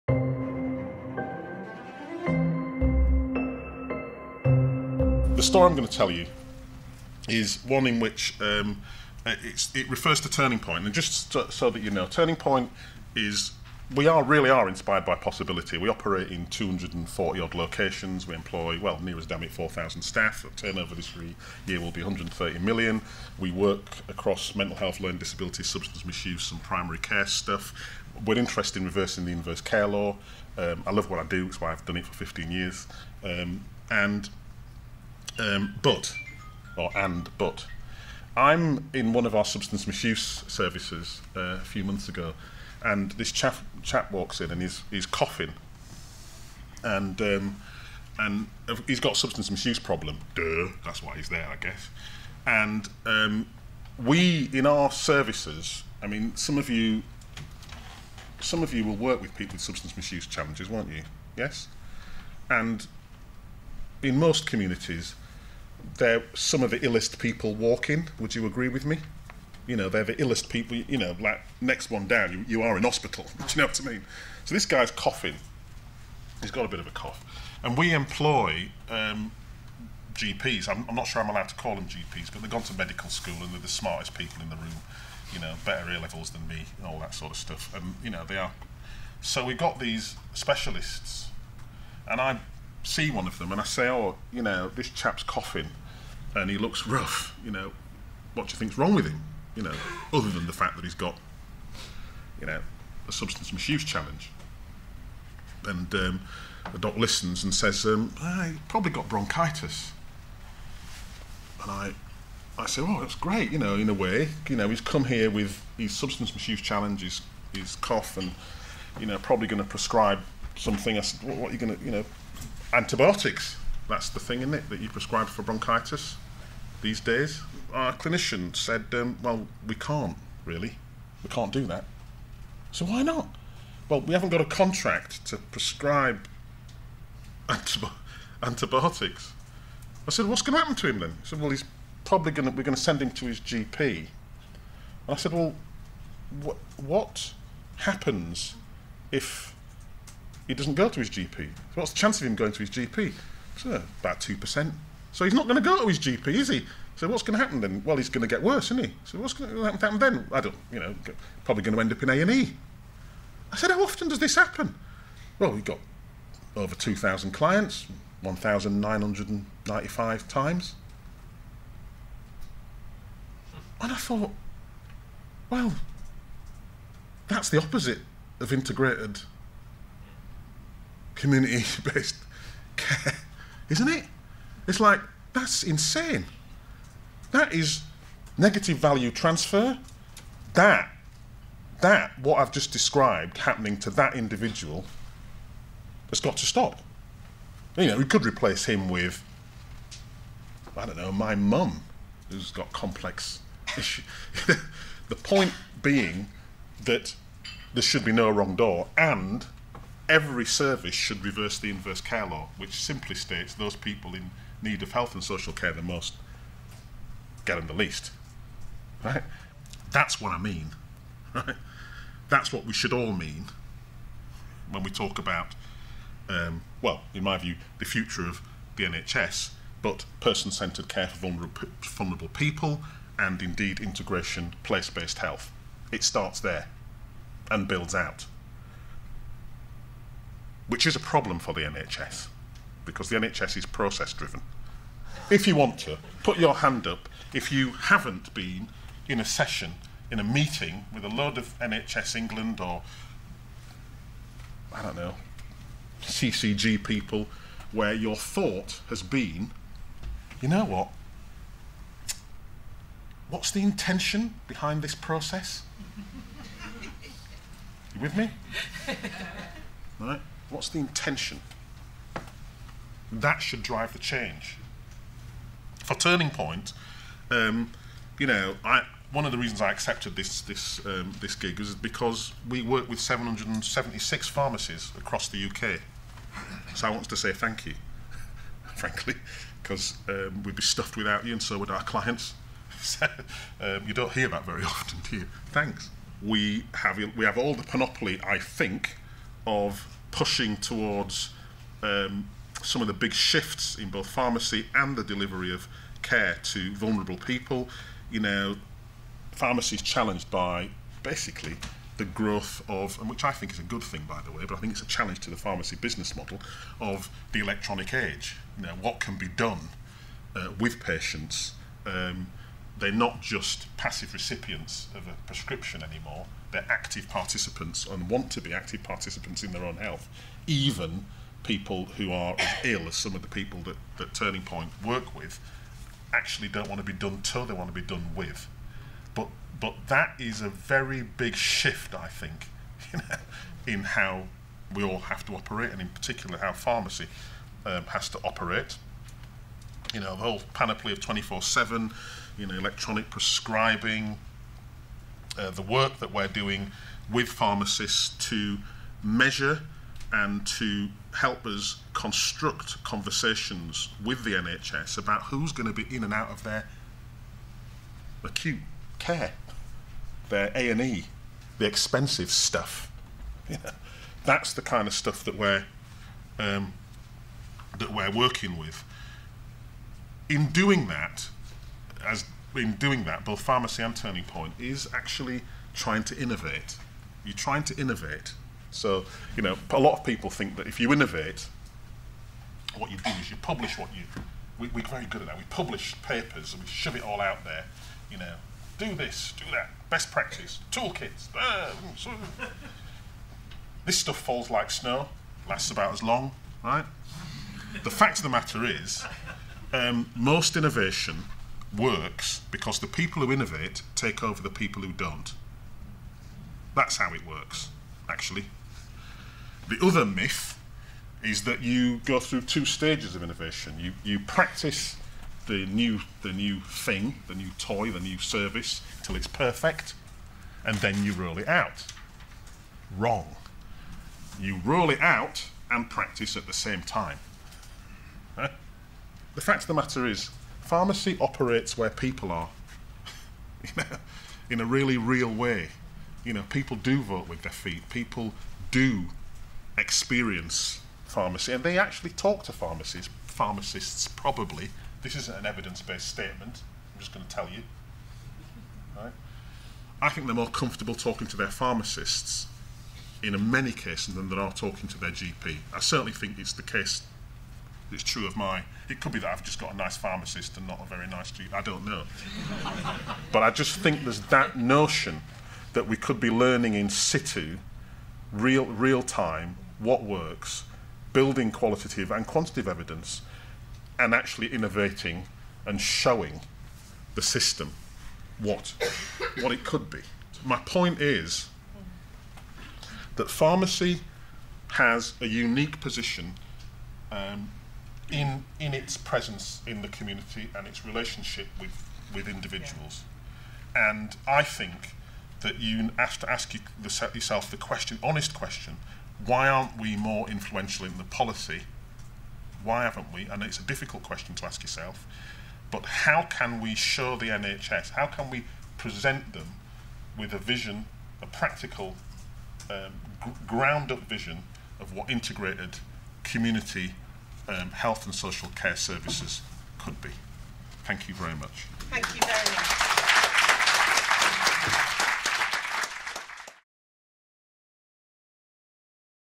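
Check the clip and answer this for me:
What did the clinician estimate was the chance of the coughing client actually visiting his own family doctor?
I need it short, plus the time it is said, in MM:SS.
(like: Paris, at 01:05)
2%, at 02:34.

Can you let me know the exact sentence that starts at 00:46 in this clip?
And, um, and uh, he's got substance misuse problem.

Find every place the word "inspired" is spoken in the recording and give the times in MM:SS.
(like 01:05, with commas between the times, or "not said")
00:14.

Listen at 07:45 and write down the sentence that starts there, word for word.
I certainly think it's the case it's true of my.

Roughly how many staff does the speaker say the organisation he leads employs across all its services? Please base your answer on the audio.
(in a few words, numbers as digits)
4,000.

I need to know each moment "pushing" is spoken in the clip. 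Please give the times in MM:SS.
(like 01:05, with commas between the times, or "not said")
05:00.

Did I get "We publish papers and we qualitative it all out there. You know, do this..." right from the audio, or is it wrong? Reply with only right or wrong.
wrong.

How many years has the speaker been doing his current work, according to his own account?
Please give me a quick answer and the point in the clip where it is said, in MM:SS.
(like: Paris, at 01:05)
15 years, at 00:32.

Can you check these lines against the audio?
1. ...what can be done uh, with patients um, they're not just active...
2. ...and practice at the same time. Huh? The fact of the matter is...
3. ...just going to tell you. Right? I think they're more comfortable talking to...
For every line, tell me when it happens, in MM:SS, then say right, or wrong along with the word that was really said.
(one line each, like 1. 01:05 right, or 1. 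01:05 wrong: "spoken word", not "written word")
1. 05:18 wrong: "passive", not "active"
2. 07:15 right
3. 07:37 right.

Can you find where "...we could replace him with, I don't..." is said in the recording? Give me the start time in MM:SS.
03:17.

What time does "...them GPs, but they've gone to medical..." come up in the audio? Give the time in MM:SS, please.
01:21.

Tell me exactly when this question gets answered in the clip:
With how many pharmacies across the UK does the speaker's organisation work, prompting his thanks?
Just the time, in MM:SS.
04:42.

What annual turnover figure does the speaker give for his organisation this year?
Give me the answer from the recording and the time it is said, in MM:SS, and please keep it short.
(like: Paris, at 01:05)
130 million, at 00:22.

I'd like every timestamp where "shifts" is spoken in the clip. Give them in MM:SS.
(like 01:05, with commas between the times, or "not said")
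05:03, 05:41.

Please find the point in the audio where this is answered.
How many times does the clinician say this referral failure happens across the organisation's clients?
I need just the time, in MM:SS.
02:48.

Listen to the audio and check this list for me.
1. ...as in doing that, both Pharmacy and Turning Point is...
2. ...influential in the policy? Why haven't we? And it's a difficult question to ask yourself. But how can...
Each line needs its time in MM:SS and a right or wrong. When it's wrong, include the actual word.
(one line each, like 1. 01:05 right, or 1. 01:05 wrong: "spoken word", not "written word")
1. 06:22 right
2. 08:30 right.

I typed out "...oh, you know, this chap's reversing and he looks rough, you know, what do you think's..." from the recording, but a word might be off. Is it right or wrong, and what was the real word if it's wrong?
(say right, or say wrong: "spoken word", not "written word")
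wrong: "coughing", not "reversing".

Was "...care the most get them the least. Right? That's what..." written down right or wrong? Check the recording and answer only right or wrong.
right.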